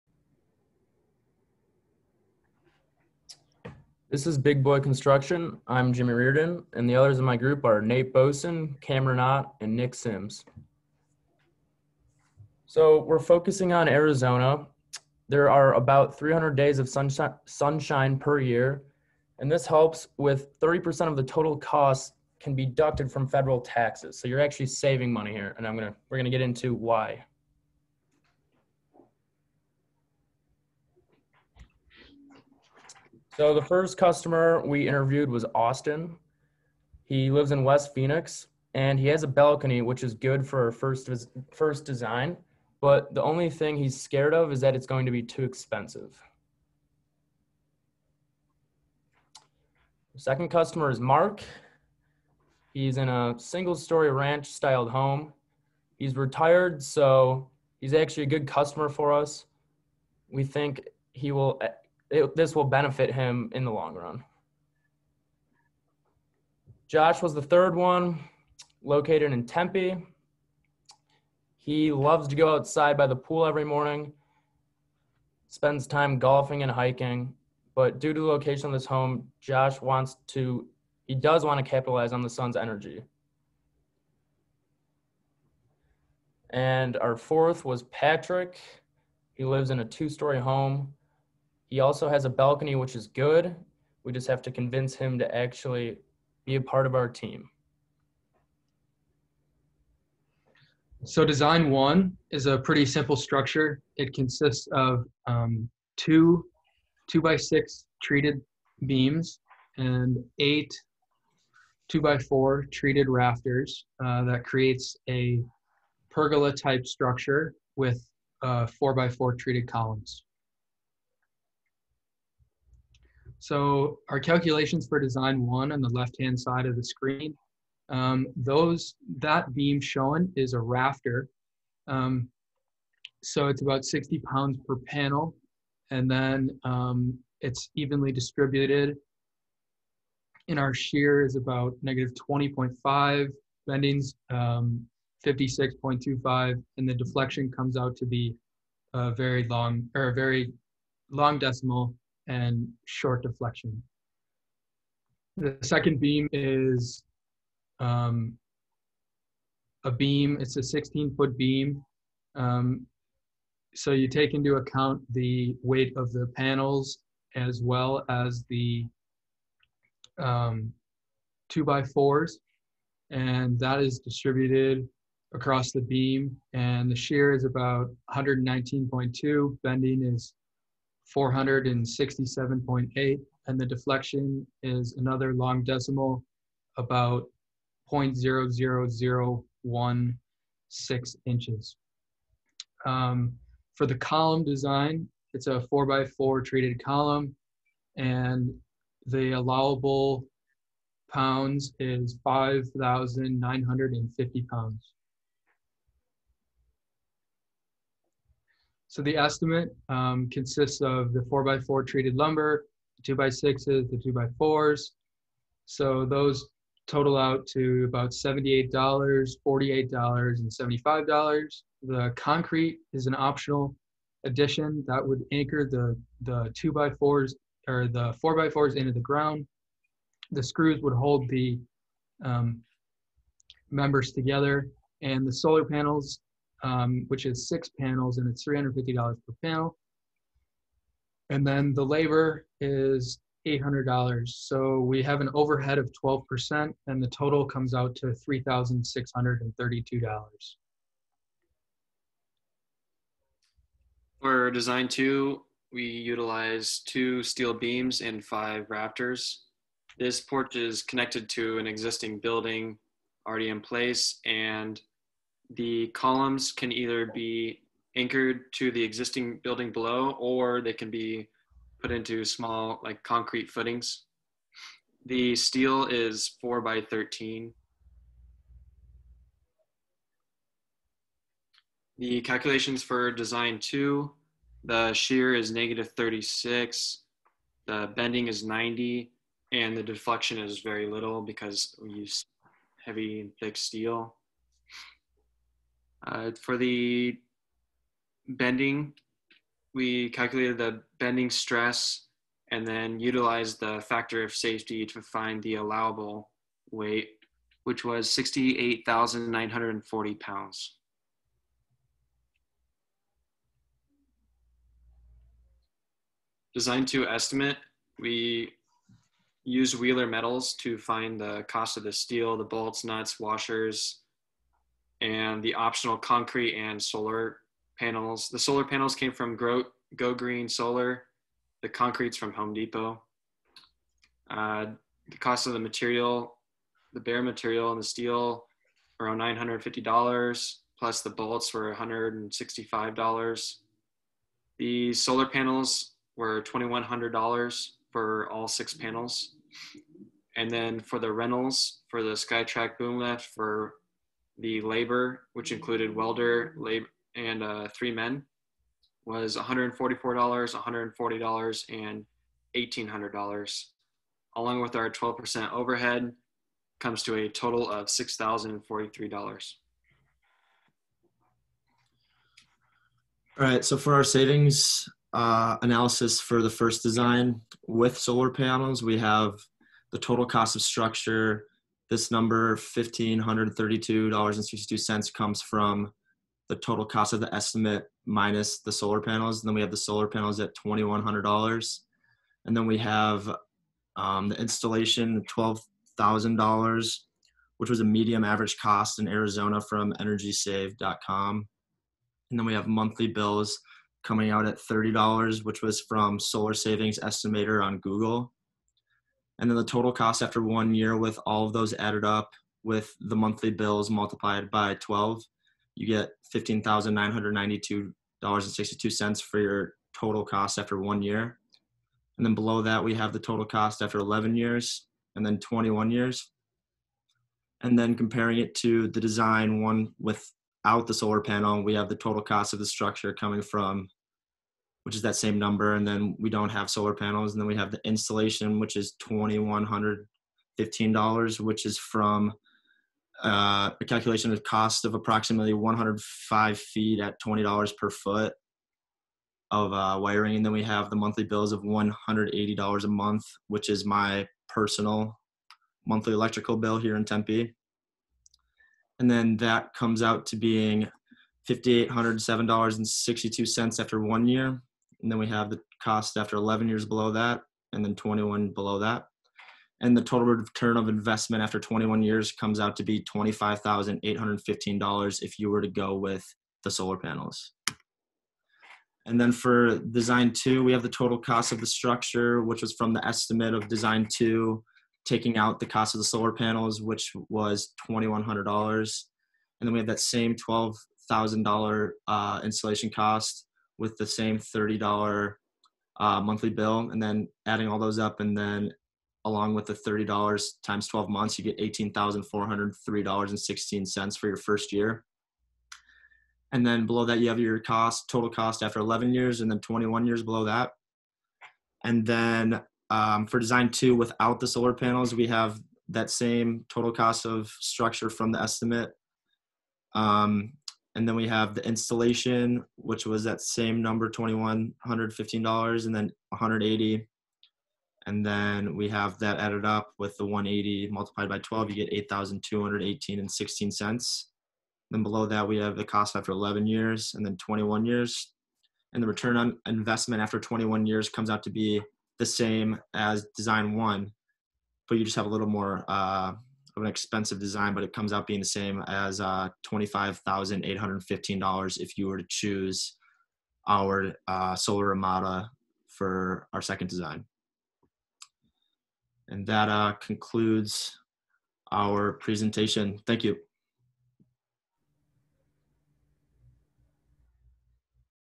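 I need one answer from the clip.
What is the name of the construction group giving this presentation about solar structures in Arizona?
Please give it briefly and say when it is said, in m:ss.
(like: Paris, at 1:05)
Big Boy Construction, at 0:04.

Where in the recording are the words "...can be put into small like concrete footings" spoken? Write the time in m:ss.
4:30.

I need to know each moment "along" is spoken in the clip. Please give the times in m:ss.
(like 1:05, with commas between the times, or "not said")
6:04, 8:19.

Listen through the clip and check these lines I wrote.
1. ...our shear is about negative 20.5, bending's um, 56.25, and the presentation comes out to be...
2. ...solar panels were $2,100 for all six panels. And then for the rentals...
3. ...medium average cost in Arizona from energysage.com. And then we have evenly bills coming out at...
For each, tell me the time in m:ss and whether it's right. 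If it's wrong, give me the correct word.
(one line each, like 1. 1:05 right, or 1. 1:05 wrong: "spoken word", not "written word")
1. 2:20 wrong: "deflection", not "presentation"
2. 5:44 right
3. 6:37 wrong: "monthly", not "evenly".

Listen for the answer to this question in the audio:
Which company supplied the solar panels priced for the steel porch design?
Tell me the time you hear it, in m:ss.
5:29.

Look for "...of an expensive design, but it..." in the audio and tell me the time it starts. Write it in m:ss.
9:06.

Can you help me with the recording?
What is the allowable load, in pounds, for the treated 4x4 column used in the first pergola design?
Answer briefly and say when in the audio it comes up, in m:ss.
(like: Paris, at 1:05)
5,950 pounds, at 3:22.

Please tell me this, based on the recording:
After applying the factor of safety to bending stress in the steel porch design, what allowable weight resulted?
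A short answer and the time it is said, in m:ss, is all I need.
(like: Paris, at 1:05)
68,940 pounds, at 5:08.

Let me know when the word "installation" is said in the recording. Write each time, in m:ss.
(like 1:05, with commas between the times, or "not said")
6:34, 7:17, 8:12, 8:41.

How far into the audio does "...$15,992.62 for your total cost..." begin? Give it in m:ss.
6:56.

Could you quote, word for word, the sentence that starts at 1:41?
So design one is a pretty simple structure.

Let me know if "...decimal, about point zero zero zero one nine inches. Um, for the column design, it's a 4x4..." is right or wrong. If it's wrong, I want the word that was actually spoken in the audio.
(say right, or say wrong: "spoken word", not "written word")
wrong: "six", not "nine".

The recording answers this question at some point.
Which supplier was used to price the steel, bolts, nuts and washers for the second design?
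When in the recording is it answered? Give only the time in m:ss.
5:19.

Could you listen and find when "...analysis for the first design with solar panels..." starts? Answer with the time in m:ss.
6:15.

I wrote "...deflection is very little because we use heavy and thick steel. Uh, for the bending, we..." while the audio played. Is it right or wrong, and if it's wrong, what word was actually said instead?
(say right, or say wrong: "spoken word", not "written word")
right.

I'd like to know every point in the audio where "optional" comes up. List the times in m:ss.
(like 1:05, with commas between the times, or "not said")
3:43, 5:25.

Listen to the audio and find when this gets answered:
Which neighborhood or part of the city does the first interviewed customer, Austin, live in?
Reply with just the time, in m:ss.
0:37.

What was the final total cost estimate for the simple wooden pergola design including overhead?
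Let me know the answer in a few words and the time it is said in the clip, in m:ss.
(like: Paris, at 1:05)
$3,632, at 4:08.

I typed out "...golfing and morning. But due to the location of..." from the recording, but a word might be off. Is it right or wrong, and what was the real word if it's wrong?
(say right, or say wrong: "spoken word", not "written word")
wrong: "hiking", not "morning".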